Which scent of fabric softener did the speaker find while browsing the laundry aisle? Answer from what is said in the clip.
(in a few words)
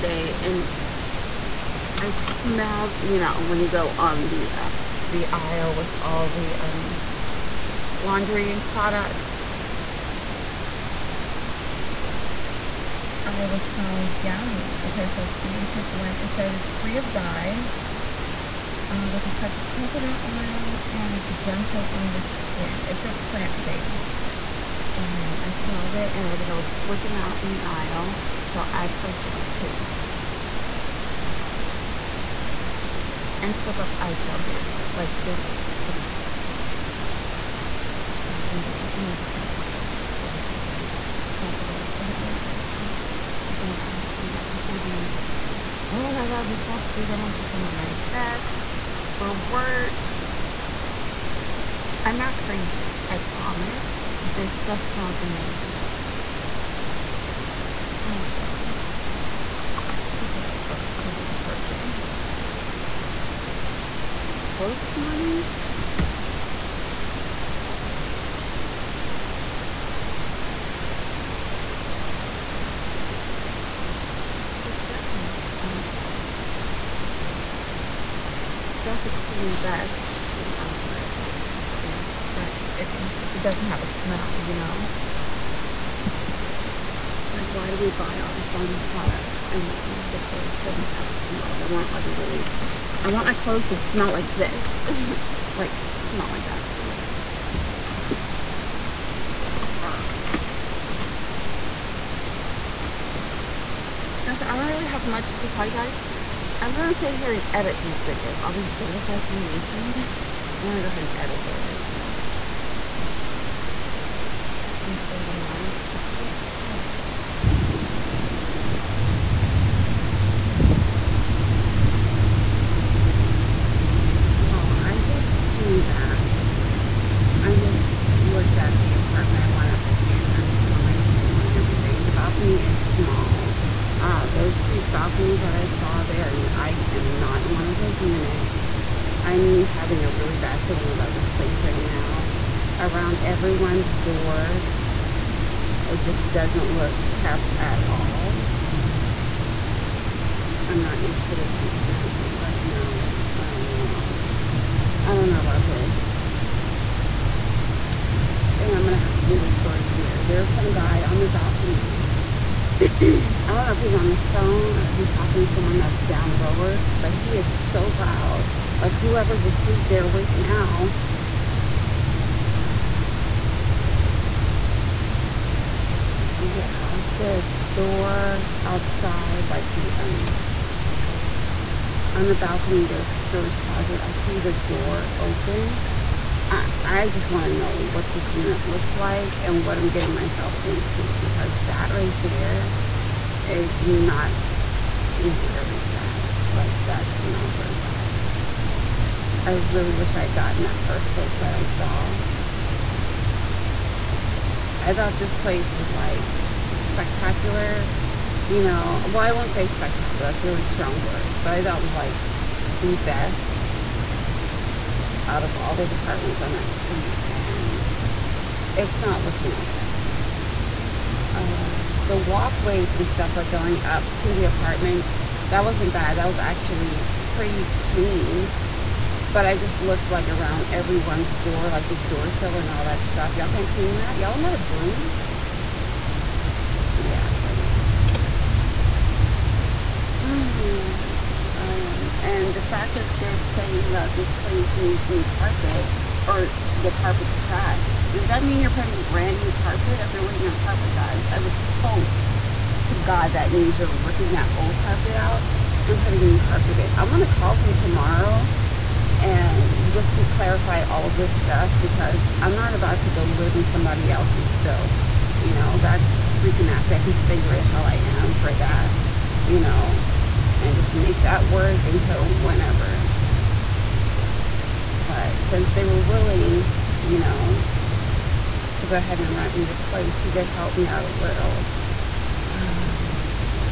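Nature Blend.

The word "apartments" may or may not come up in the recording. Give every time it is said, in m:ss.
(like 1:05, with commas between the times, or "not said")
2:09, 3:35, 3:44.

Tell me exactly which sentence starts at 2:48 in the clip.
Like whoever's asleep, they're awake now.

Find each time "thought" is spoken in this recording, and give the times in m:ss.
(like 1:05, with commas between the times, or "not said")
3:24, 3:31.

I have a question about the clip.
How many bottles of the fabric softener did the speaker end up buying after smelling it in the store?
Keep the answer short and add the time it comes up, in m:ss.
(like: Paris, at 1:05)
2, at 0:29.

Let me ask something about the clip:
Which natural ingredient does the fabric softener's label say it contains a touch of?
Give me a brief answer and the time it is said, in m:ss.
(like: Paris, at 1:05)
coconut oil, at 0:19.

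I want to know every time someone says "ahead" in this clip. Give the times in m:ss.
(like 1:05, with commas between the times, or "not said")
1:50, 4:38.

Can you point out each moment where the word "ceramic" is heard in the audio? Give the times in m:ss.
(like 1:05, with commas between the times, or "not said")
not said.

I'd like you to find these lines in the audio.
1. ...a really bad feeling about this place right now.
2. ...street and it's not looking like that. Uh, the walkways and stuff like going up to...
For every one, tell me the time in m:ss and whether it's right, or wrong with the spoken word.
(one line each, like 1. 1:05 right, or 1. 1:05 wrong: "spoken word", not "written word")
1. 2:20 right
2. 3:36 right.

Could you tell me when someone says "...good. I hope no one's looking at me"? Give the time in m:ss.
0:41.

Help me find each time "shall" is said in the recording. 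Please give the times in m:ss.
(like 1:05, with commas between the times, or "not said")
0:34.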